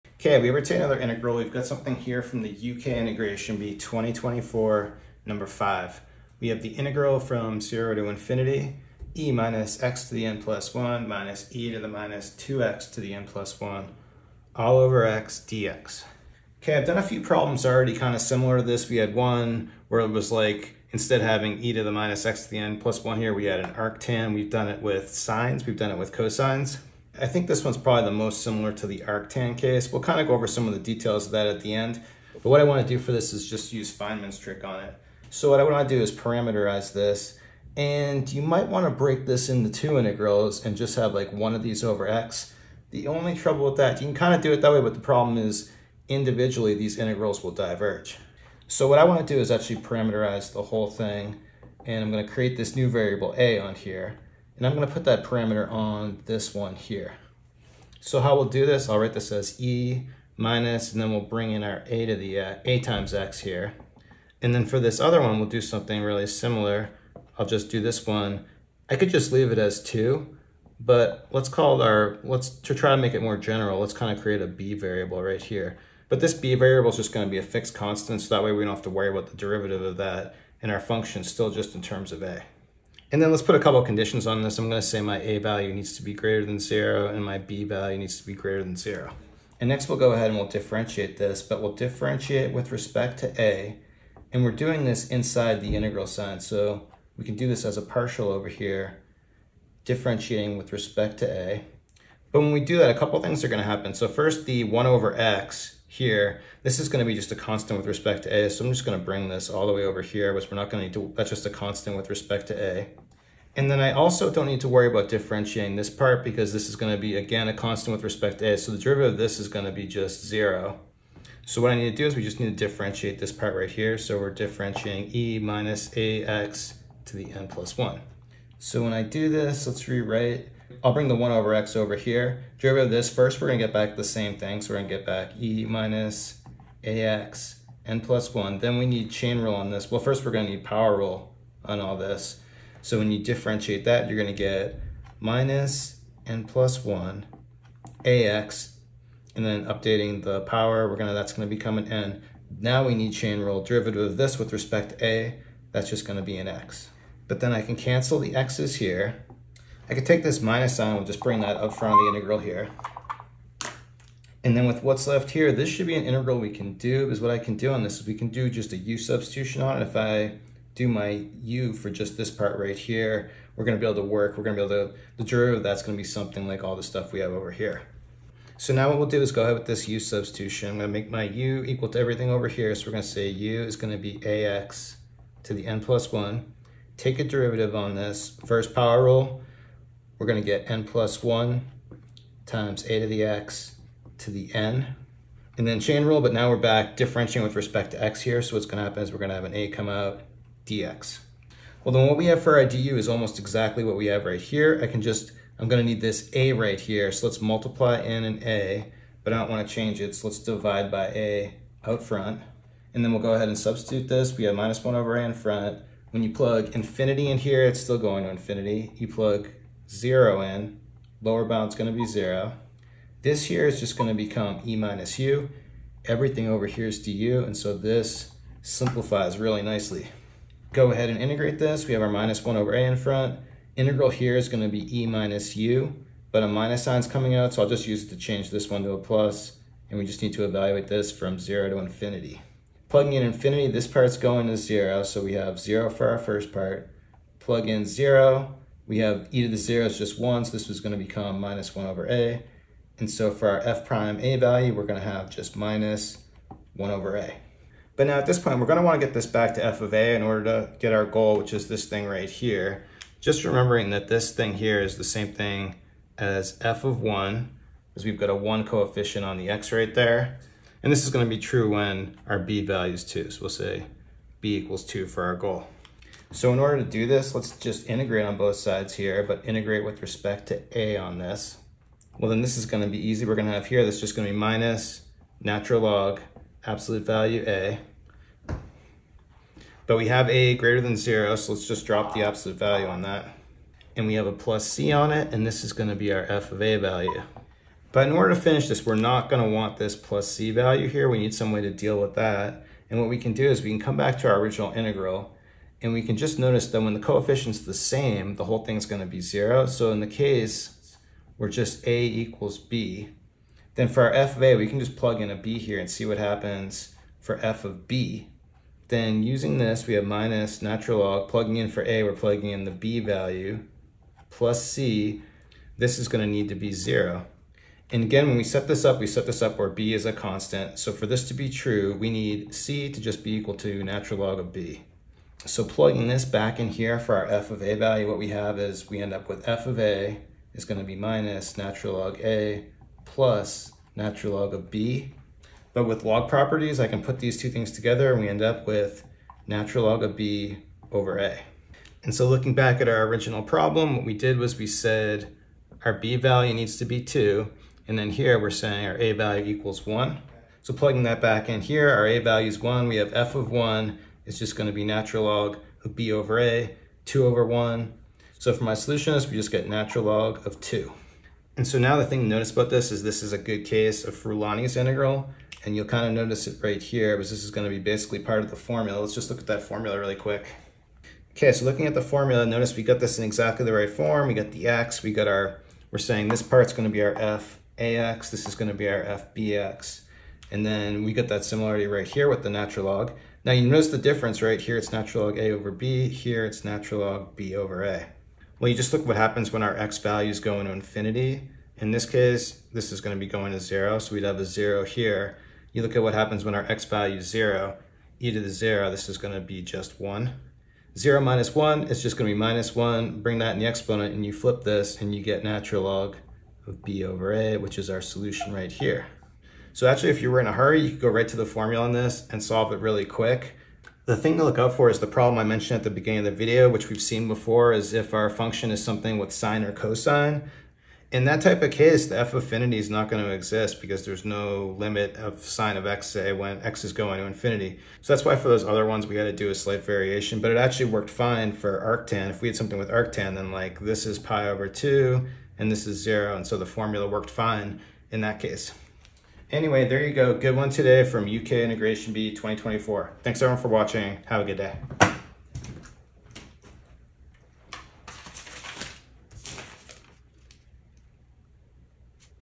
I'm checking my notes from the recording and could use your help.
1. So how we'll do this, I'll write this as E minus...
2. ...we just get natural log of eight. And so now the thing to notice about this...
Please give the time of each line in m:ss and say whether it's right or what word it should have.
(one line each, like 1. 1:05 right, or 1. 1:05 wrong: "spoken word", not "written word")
1. 0:57 right
2. 6:09 wrong: "two", not "eight".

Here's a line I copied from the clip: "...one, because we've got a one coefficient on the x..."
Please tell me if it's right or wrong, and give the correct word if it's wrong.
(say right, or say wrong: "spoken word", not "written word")
right.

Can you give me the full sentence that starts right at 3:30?
So let's divide by a out front.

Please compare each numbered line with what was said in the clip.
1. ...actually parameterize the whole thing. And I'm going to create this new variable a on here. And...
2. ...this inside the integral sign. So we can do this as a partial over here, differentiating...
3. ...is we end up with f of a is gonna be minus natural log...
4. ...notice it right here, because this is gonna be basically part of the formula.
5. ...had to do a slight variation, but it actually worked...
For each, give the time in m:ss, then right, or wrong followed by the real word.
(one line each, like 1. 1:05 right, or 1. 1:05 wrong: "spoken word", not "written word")
1. 0:49 right
2. 1:34 right
3. 5:38 right
4. 6:16 right
5. 7:19 right.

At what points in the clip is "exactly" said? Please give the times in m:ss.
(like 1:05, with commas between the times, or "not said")
3:23, 6:23.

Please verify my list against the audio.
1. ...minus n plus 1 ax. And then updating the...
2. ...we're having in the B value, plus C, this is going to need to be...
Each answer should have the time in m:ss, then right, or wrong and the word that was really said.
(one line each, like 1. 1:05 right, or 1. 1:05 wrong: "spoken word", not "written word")
1. 2:25 right
2. 5:22 wrong: "plugging", not "having".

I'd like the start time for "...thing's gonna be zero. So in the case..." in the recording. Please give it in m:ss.
5:08.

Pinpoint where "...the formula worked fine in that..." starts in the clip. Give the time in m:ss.
7:26.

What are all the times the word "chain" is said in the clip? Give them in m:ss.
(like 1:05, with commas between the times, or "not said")
2:19, 2:33, 3:15.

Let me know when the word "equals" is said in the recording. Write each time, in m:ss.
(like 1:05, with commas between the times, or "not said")
3:01, 4:34, 5:12, 5:33, 5:59.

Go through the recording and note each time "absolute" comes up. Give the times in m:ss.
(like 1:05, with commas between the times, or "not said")
4:46, 4:52.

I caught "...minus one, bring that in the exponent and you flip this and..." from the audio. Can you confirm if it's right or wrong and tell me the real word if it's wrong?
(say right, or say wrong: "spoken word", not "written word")
right.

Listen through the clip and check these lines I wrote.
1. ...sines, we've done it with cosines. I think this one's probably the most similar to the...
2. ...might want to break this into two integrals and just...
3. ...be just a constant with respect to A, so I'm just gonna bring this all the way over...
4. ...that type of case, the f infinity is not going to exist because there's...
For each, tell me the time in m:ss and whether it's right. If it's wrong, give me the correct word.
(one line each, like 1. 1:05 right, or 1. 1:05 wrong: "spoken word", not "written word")
1. 0:25 right
2. 0:38 right
3. 1:47 right
4. 7:11 wrong: "affinity", not "infinity".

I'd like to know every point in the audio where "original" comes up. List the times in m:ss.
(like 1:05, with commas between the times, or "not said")
5:04, 5:53.